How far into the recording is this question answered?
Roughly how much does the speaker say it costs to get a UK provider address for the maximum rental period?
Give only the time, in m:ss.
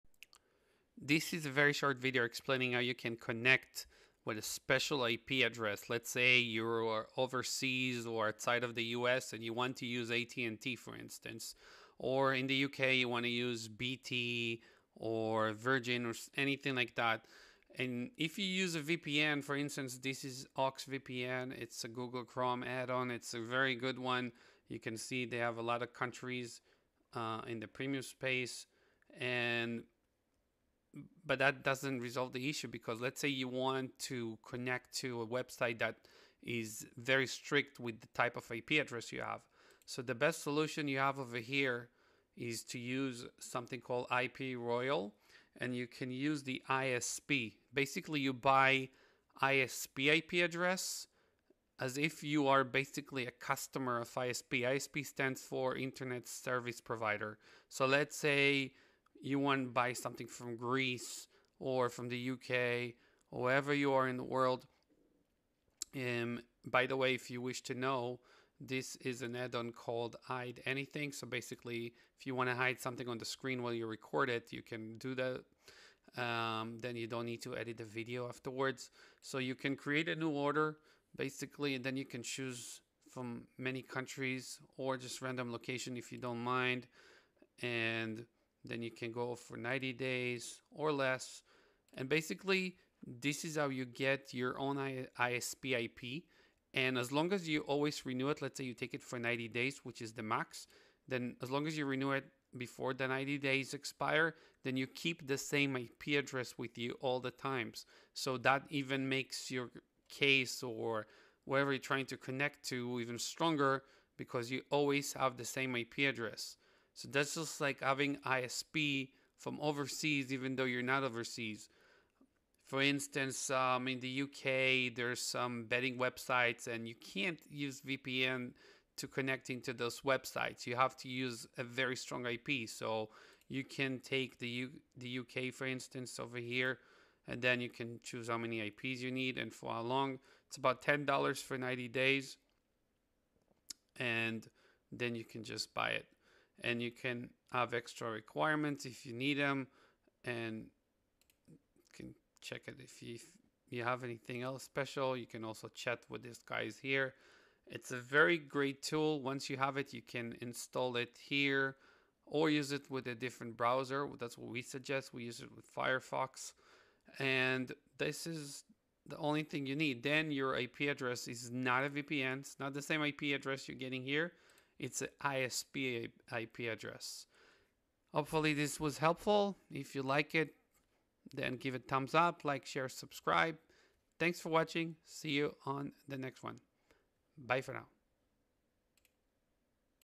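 2:20.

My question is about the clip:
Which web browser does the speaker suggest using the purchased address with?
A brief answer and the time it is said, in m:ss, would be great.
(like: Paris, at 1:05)
Firefox, at 2:45.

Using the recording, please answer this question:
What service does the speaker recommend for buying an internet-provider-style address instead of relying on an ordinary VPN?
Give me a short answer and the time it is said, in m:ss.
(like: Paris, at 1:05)
IP Royal, at 0:44.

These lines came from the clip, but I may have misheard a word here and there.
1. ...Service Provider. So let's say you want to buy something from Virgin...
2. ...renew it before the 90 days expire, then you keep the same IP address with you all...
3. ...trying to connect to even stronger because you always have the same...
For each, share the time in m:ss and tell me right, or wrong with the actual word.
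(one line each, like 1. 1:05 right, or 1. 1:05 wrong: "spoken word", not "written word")
1. 0:56 wrong: "Greece", not "Virgin"
2. 1:41 right
3. 1:51 right.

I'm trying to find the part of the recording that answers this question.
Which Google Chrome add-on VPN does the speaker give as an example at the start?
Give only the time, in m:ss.
0:20.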